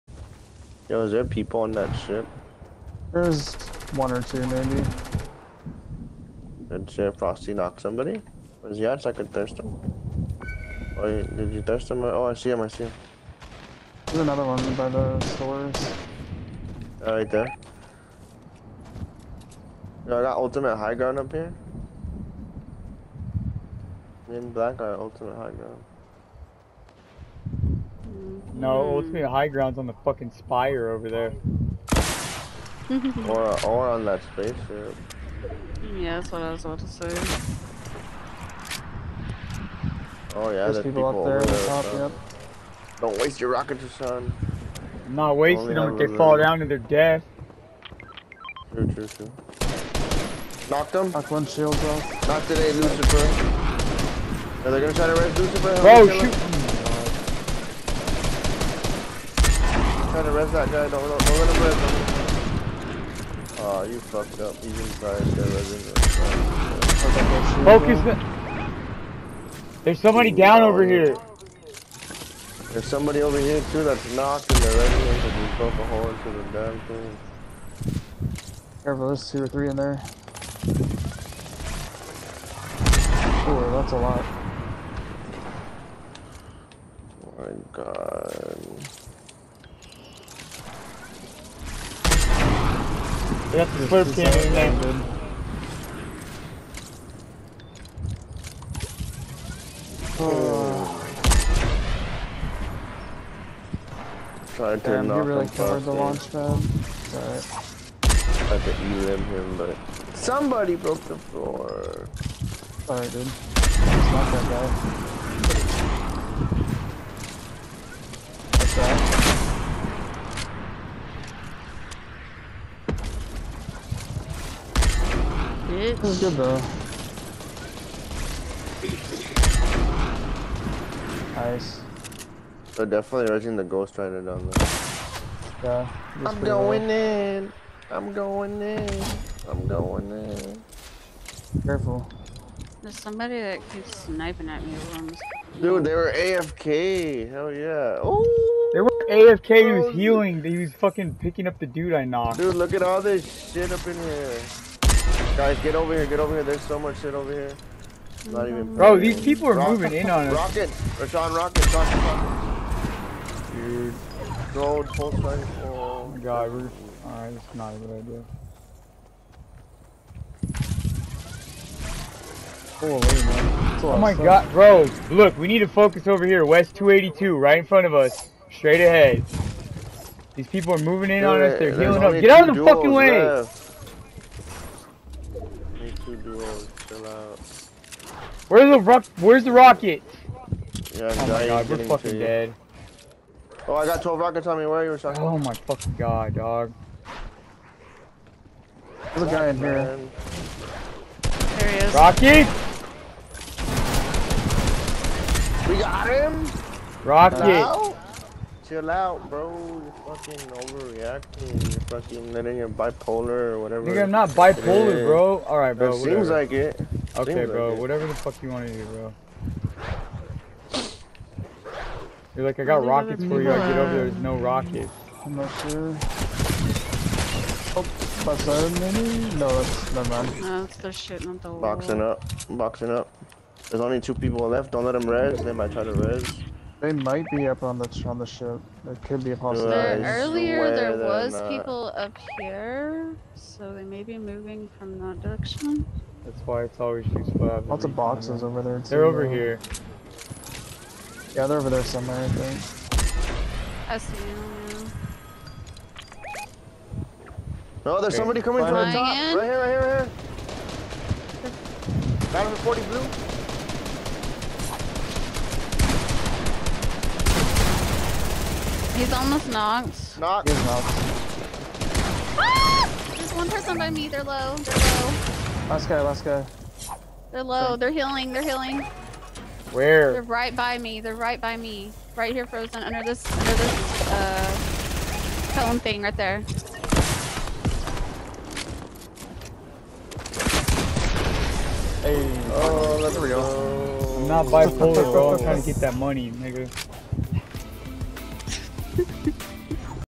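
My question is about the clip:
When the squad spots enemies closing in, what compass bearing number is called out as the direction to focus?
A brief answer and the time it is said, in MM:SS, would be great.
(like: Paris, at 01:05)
282, at 02:56.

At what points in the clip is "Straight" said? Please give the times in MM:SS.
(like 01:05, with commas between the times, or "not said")
02:58.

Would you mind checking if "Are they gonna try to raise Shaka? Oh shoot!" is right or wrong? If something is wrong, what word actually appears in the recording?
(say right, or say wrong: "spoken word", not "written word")
wrong: "Lucifer", not "Shaka".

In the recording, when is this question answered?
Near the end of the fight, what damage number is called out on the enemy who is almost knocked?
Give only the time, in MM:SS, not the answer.
04:22.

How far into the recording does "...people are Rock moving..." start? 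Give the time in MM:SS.
02:39.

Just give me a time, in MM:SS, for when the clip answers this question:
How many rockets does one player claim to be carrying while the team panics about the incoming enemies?
03:13.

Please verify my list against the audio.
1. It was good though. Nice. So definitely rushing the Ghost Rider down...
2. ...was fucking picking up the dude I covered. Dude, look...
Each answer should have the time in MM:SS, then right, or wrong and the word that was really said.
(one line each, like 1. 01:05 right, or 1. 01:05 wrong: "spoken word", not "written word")
1. 02:05 right
2. 02:30 wrong: "knocked", not "covered".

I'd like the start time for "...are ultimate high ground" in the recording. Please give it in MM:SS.
00:24.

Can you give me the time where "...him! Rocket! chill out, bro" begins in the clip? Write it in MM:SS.
03:26.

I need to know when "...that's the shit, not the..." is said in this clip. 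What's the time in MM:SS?
03:50.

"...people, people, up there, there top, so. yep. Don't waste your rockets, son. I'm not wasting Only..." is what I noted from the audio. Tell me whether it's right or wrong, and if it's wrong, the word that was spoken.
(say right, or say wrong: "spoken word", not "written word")
right.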